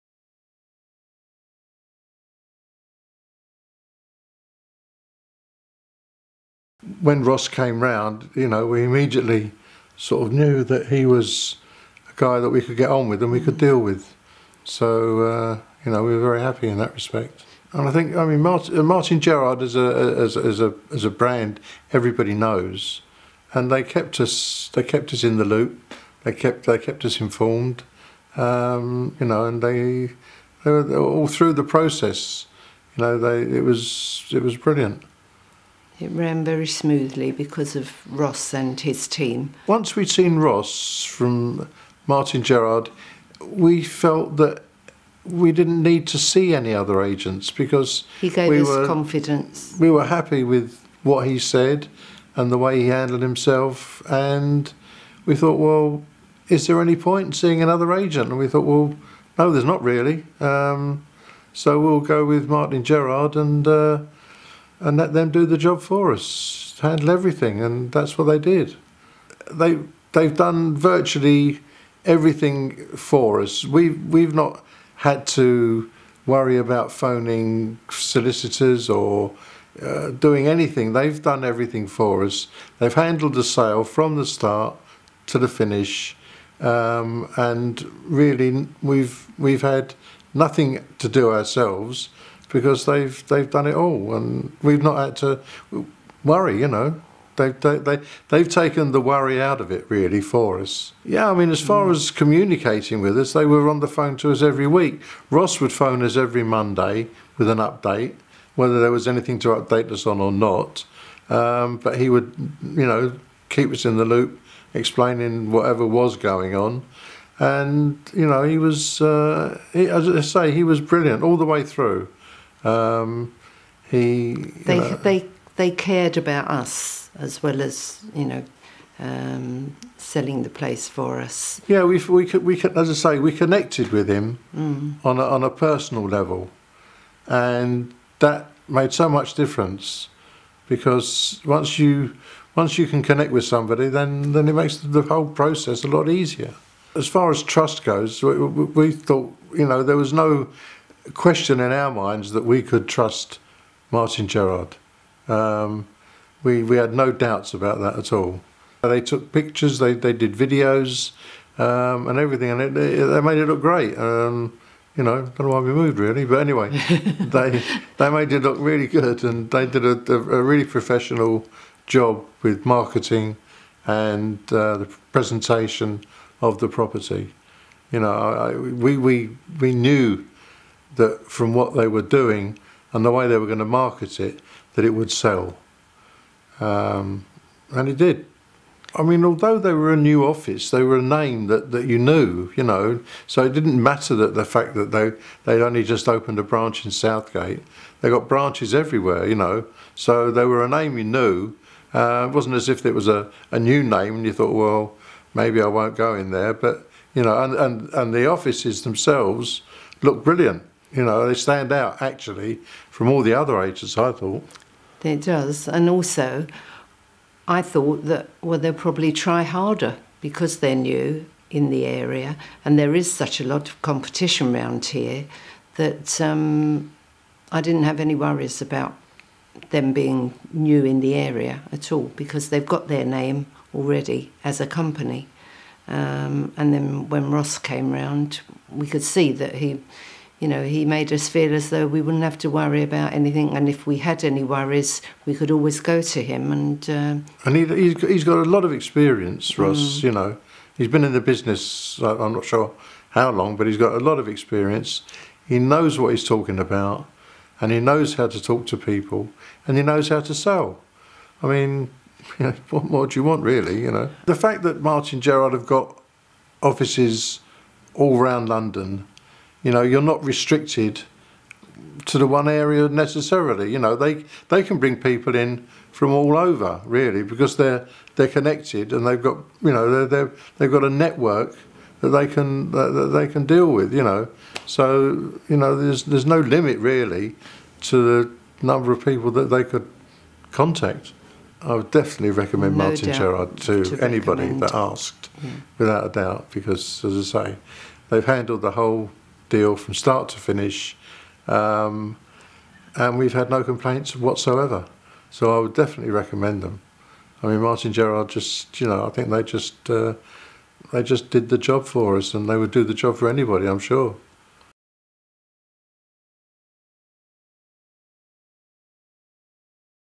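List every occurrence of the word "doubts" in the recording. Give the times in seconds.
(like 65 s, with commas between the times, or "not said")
157 s, 296 s.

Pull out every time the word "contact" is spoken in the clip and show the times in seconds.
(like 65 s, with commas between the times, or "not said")
290 s.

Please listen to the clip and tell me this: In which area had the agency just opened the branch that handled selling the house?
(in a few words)
Southgate.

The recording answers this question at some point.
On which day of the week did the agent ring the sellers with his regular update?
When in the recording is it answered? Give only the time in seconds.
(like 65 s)
106 s.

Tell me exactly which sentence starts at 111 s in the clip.
Um, but he would, you know, keep us in the loop, explaining whatever was going on.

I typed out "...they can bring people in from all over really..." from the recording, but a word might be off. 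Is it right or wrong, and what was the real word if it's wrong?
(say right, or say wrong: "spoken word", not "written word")
right.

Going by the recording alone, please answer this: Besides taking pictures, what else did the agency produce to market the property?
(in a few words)
videos.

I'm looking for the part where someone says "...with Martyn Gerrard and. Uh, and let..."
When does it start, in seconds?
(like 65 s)
62 s.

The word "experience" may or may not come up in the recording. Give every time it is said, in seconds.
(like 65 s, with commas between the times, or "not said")
248 s, 254 s.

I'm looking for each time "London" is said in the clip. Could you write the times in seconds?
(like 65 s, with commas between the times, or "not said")
268 s.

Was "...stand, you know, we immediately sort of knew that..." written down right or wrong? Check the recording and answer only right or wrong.
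wrong.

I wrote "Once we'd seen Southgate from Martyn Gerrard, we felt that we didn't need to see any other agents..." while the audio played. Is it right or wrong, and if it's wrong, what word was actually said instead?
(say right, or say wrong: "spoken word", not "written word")
wrong: "Ross", not "Southgate".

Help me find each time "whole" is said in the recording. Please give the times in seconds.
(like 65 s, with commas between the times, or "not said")
145 s, 298 s.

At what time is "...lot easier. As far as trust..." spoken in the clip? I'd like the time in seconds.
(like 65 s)
145 s.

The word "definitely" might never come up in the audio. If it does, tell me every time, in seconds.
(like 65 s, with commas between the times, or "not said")
291 s, 305 s.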